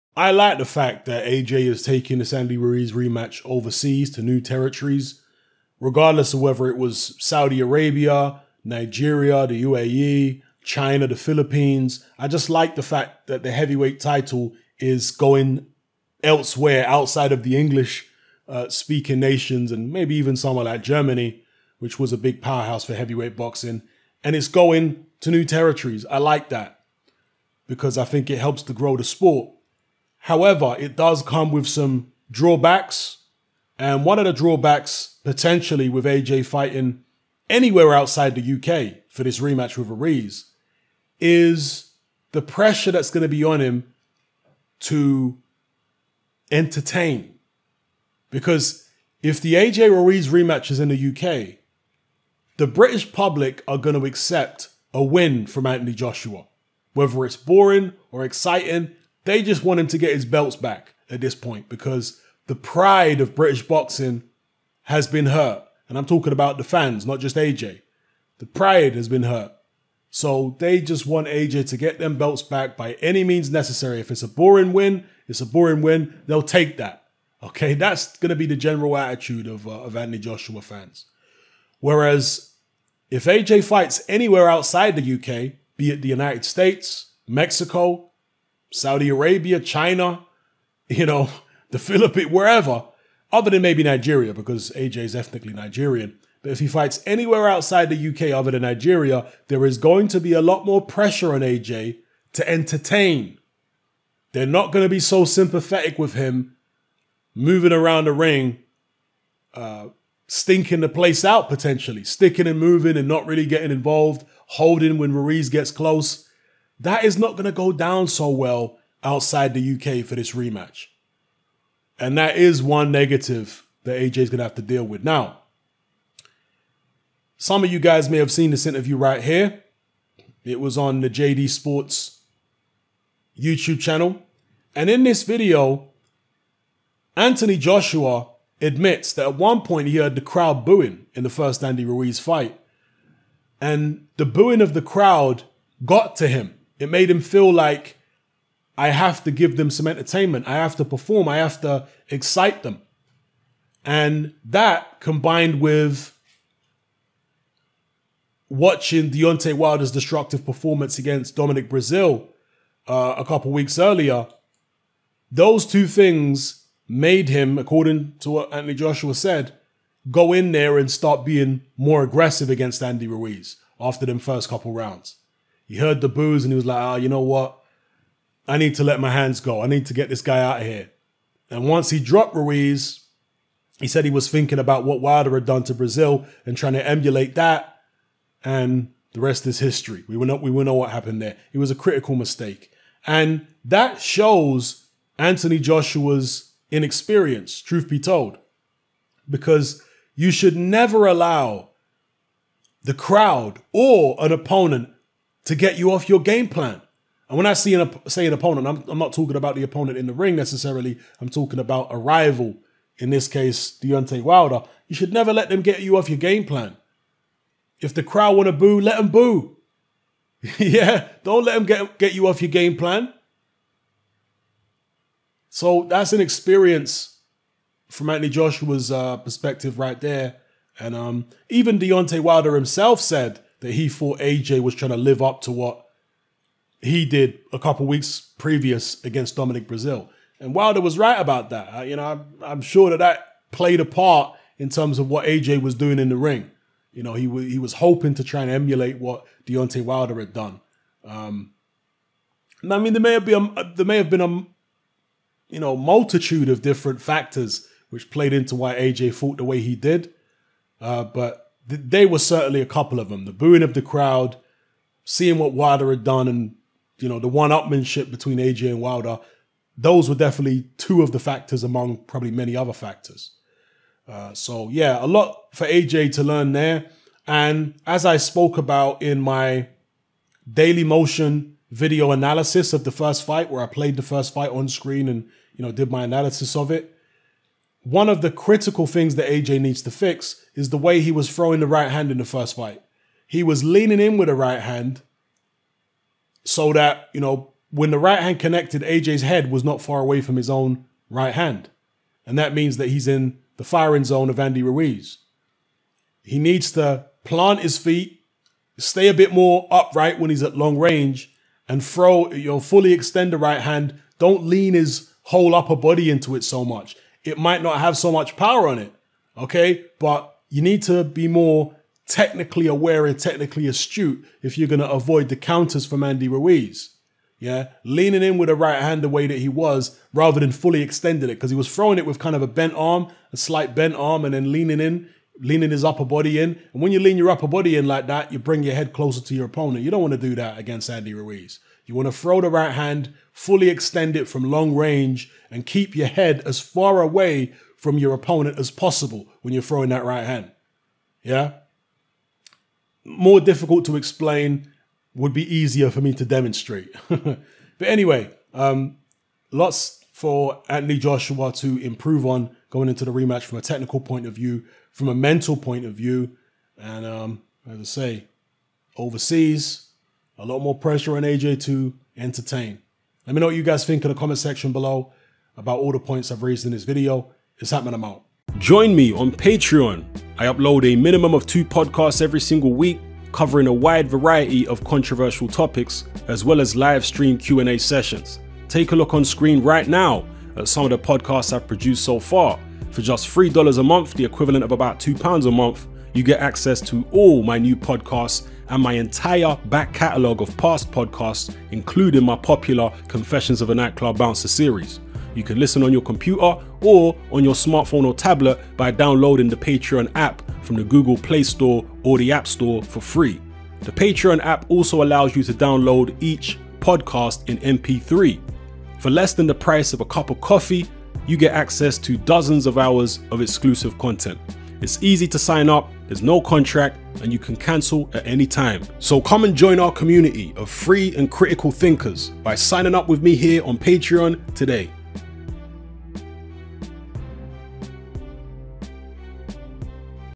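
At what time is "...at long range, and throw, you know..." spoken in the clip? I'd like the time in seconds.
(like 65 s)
310 s.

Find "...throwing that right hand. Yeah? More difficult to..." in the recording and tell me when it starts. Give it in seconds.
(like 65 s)
349 s.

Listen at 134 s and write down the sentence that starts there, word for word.
And in this video, Anthony Joshua admits that at one point he heard the crowd booing in the first Andy Ruiz fight.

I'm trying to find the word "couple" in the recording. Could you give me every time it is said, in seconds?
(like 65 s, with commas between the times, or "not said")
163 s, 174 s, 237 s, 262 s.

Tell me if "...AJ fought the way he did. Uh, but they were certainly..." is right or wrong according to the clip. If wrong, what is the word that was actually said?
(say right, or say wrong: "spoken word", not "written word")
right.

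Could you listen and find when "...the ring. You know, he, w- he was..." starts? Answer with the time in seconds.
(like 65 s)
246 s.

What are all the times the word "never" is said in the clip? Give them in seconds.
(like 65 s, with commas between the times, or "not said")
200 s, 215 s.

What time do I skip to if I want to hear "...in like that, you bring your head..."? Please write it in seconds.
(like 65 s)
337 s.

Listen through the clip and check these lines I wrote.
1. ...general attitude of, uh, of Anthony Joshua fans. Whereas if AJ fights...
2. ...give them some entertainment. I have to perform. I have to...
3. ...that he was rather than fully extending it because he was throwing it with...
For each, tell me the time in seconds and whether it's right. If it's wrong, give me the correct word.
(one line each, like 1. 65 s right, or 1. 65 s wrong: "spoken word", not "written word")
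1. 78 s right
2. 149 s right
3. 329 s right.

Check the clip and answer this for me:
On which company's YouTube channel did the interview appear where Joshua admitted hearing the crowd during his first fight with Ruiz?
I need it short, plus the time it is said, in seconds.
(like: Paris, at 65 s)
JD Sports, at 131 s.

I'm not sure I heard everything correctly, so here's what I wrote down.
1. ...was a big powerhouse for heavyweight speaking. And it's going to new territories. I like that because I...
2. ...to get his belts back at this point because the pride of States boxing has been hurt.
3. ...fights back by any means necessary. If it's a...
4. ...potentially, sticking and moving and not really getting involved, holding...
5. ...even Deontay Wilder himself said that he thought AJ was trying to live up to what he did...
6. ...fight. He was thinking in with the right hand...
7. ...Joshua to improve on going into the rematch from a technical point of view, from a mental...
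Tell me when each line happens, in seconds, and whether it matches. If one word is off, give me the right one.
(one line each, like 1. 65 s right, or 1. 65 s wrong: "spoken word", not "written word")
1. 21 s wrong: "boxing", not "speaking"
2. 59 s wrong: "British", not "States"
3. 72 s wrong: "belts", not "fights"
4. 111 s right
5. 231 s right
6. 292 s wrong: "leaning", not "thinking"
7. 360 s right.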